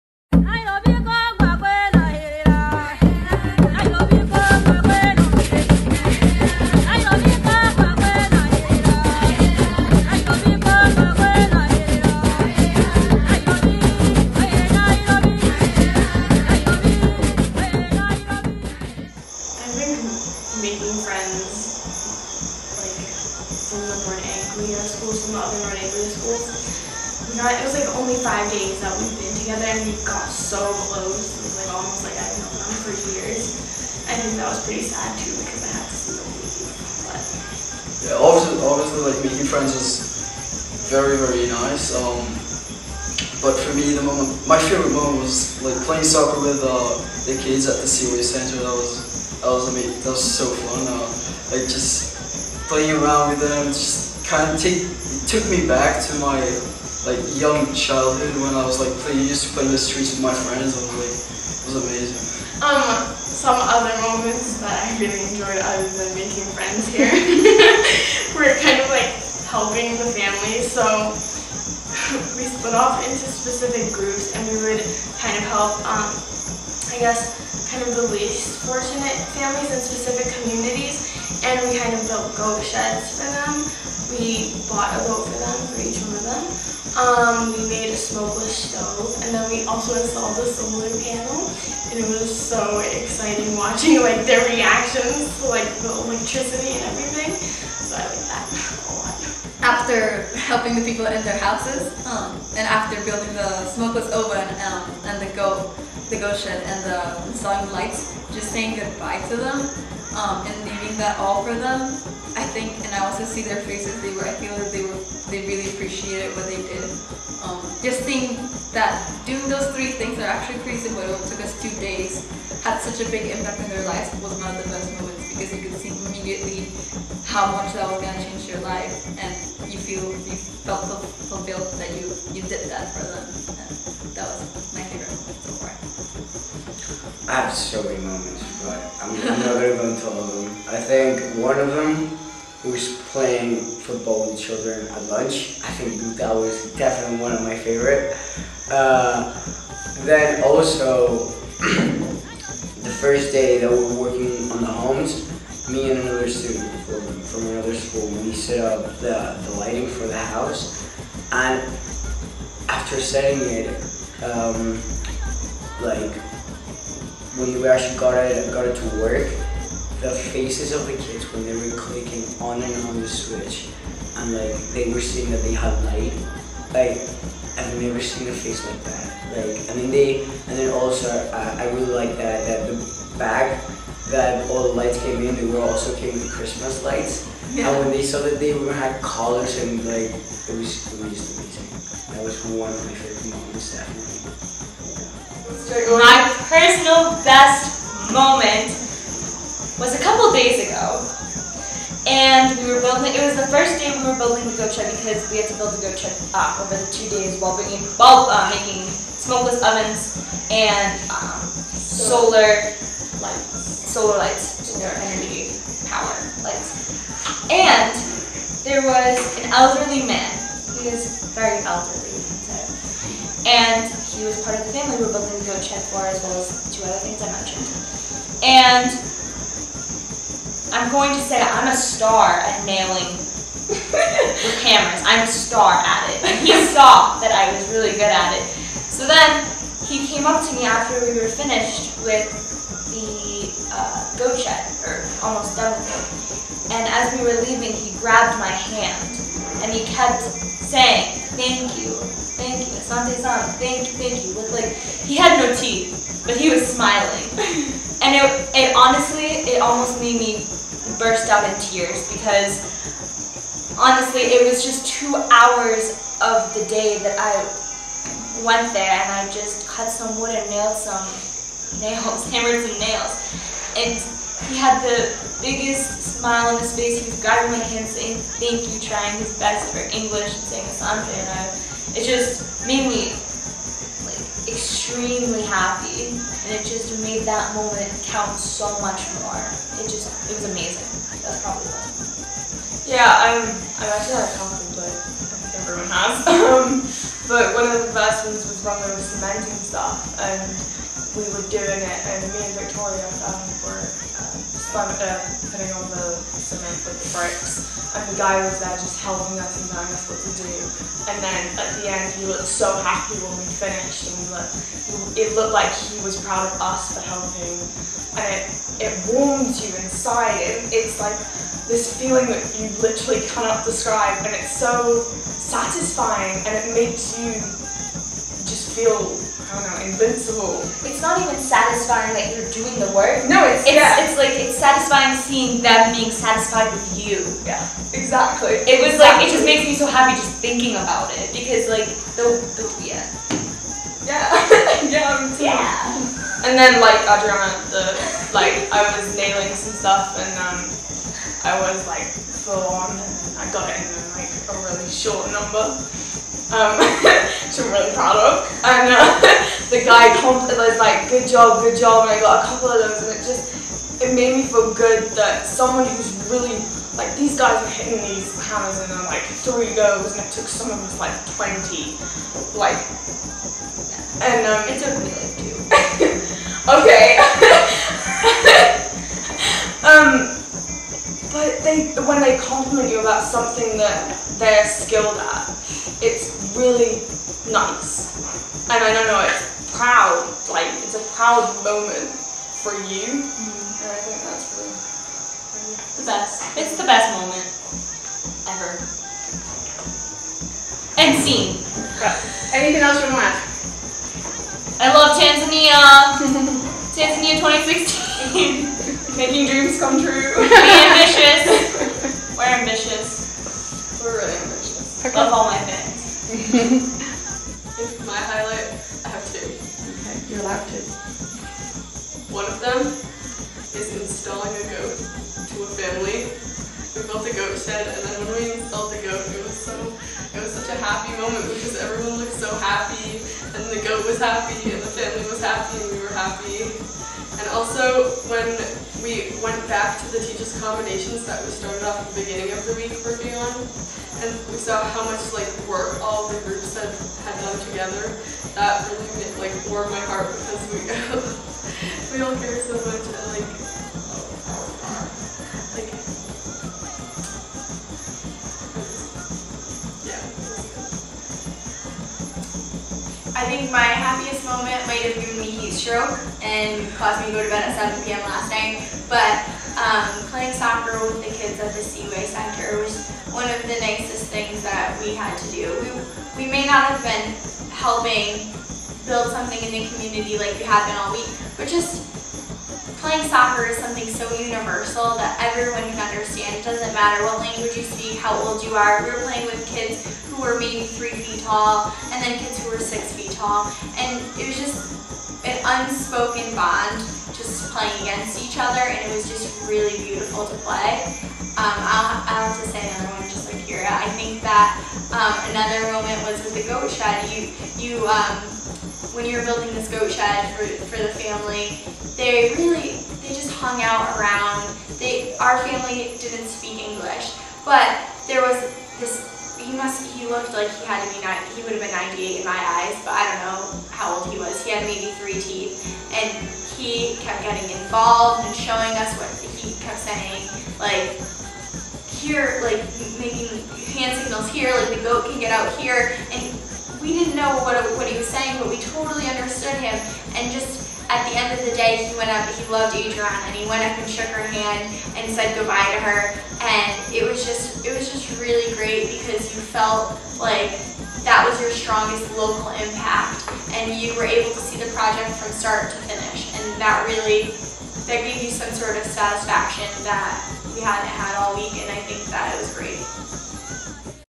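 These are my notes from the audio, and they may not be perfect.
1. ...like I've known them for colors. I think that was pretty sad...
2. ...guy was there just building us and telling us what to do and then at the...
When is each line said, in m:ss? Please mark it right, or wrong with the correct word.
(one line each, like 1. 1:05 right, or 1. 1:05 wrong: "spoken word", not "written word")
1. 0:32 wrong: "years", not "colors"
2. 5:08 wrong: "helping", not "building".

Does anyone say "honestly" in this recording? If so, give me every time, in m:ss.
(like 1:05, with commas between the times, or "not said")
4:18, 4:23.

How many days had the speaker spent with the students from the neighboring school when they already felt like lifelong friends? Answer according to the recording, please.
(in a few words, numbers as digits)
5 days.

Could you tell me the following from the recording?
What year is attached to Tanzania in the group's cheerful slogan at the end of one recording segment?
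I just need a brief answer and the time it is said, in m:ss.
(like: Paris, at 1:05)
2016, at 6:47.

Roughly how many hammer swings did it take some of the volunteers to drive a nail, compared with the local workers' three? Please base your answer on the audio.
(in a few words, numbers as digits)
20.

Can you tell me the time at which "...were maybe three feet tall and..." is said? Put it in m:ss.
8:10.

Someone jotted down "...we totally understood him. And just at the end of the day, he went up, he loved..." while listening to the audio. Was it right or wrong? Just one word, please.
right.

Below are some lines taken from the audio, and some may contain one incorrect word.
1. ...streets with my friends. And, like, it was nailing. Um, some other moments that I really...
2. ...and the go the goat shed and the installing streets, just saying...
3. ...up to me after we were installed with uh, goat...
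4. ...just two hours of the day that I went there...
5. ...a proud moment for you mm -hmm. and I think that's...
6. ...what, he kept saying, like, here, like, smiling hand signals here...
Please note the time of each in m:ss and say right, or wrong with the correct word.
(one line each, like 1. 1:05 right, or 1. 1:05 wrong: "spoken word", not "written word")
1. 0:59 wrong: "amazing", not "nailing"
2. 1:45 wrong: "lights", not "streets"
3. 4:00 wrong: "finished", not "installed"
4. 4:24 right
5. 6:30 right
6. 8:49 wrong: "making", not "smiling".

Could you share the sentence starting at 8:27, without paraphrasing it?
You, you um, when you were building this goat shed for, for the family, they really, they just hung out around.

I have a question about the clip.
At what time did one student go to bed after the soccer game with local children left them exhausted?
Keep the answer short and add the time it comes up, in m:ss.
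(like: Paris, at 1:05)
7 p.m., at 7:47.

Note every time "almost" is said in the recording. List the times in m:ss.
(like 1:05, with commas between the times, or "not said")
0:31, 4:05, 4:19.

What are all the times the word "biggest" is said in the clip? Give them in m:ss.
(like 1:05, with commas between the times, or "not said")
4:35.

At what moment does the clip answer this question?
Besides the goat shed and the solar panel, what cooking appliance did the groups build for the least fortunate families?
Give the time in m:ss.
1:27.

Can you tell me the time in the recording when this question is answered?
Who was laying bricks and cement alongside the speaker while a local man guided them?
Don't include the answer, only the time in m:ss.
5:02.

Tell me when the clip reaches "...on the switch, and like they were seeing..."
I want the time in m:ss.
2:52.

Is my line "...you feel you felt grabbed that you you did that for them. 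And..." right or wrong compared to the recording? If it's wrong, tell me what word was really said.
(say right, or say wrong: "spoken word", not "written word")
wrong: "fulfilled", not "grabbed".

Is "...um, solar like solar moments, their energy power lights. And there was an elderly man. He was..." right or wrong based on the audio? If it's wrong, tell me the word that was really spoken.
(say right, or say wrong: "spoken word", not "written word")
wrong: "lights", not "moments".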